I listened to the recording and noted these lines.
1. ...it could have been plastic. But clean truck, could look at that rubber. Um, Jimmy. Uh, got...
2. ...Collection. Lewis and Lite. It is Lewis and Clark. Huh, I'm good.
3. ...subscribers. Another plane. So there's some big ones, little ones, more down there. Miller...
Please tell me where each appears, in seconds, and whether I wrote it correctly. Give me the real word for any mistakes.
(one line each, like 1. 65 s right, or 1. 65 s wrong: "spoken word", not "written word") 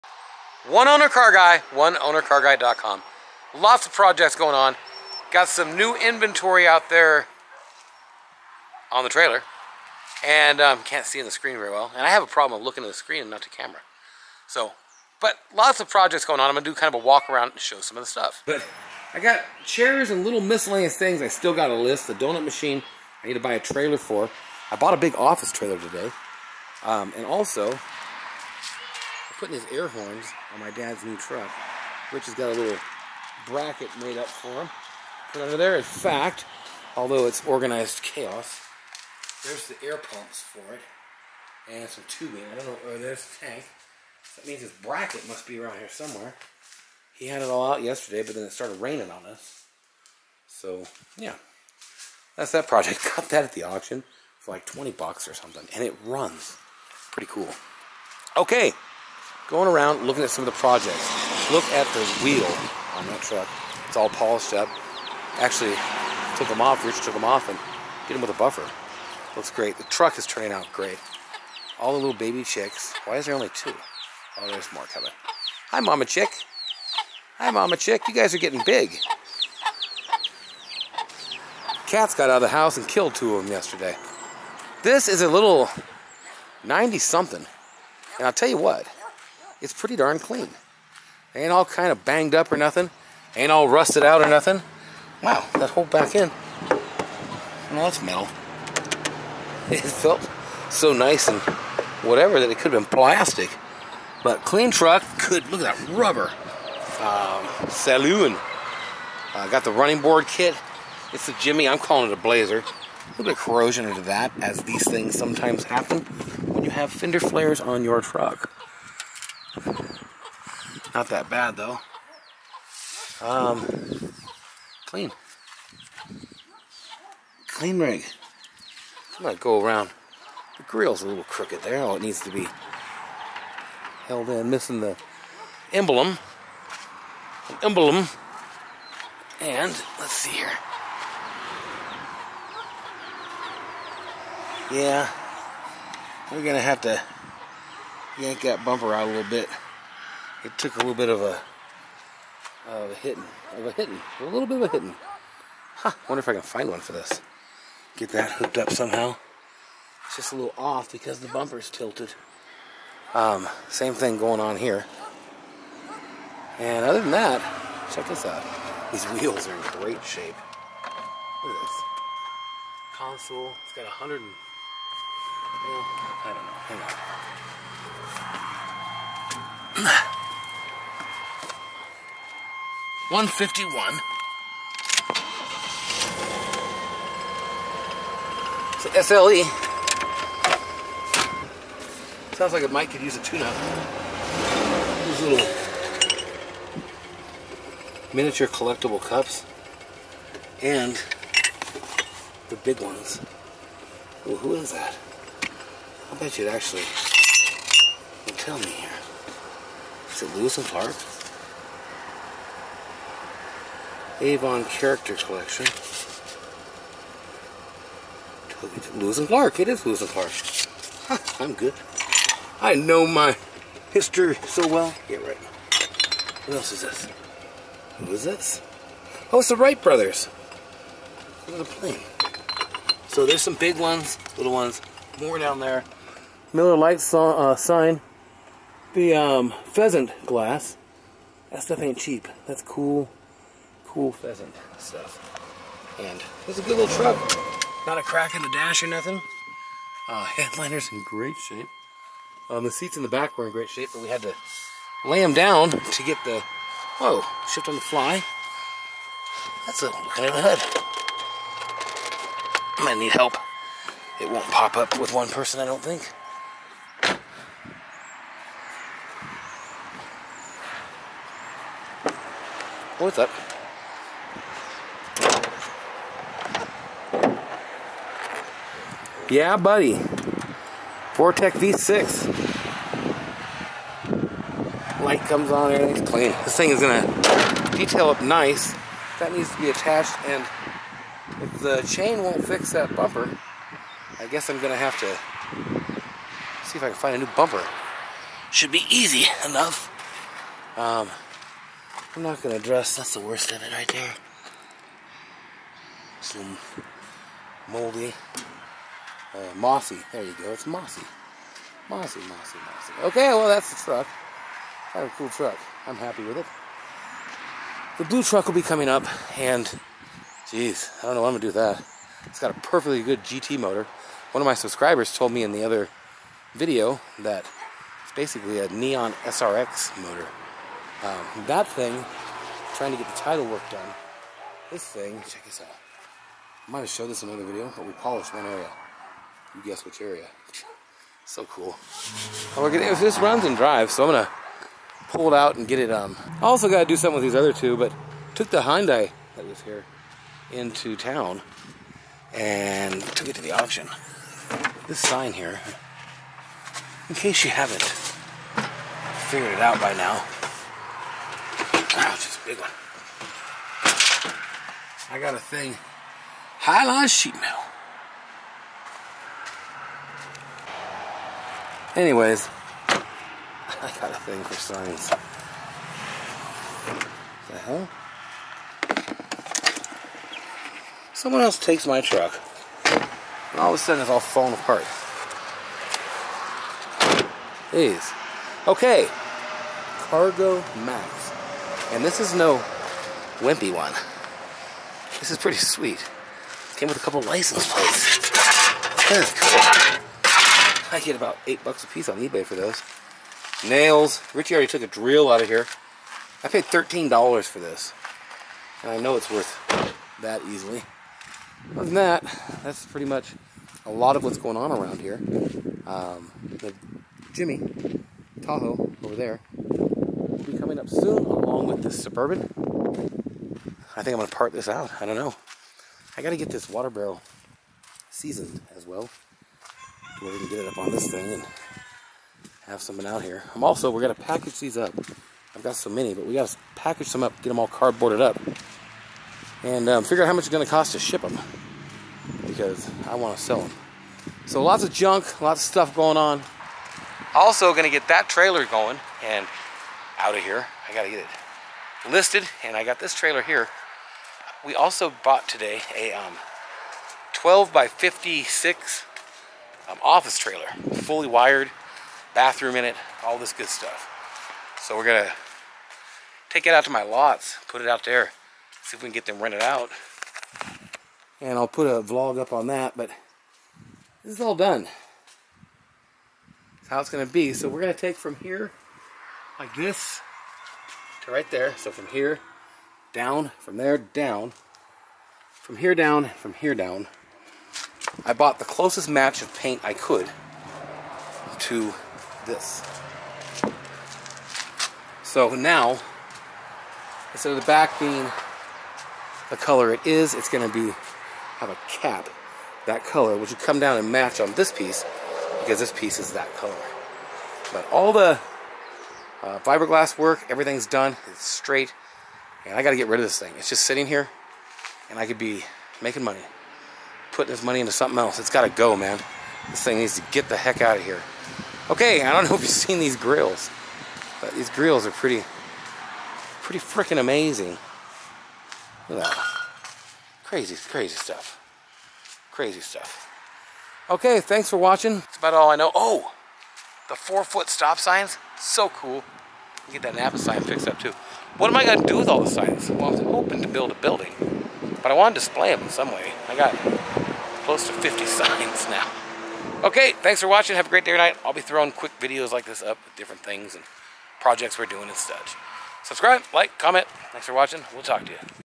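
1. 102 s wrong: "Saloon", not "Jimmy"
2. 215 s wrong: "Clark", not "Lite"
3. 229 s wrong: "brothers", not "subscribers".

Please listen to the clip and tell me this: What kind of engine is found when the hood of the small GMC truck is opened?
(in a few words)
Vortec V6.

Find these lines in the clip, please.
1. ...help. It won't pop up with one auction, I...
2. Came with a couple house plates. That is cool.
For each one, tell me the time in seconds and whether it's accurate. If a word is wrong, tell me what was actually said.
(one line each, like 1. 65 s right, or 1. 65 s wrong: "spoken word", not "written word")
1. 263 s wrong: "person", not "auction"
2. 396 s wrong: "license", not "house".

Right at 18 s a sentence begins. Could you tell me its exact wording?
But I got chairs and little miscellaneous things.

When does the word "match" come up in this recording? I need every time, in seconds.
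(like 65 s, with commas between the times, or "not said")
489 s, 504 s.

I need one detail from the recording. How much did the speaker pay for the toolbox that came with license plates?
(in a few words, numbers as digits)
$13.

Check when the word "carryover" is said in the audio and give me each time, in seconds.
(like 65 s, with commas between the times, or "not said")
not said.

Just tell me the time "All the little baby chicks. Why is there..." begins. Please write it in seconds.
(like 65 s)
71 s.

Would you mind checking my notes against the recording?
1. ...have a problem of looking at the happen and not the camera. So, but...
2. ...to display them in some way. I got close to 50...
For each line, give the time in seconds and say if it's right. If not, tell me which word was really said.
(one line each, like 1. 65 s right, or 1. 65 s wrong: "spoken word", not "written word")
1. 12 s wrong: "screen", not "happen"
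2. 545 s right.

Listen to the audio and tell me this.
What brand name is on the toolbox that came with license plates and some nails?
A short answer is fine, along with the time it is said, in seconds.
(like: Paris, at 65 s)
Cargo Max, at 390 s.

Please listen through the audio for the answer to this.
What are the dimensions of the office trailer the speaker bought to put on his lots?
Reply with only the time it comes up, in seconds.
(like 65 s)
457 s.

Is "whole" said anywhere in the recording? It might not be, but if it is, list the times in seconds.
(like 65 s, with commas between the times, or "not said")
95 s.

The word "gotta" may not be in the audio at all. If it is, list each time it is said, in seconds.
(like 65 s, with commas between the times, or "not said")
346 s, 450 s, 512 s, 518 s.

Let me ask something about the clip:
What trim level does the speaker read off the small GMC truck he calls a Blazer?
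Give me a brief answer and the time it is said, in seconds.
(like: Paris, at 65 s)
SLE, at 189 s.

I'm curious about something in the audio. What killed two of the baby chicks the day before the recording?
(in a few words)
Cats.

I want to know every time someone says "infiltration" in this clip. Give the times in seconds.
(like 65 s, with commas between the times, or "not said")
not said.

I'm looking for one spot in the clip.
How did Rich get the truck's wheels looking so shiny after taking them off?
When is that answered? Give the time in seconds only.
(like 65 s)
68 s.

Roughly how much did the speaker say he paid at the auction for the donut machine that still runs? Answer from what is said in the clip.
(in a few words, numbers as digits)
$20.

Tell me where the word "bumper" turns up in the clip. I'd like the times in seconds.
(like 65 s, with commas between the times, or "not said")
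148 s, 161 s, 292 s, 297 s.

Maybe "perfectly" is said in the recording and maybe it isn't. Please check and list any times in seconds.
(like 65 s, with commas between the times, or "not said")
322 s.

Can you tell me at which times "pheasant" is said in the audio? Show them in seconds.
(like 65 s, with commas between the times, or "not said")
239 s, 244 s.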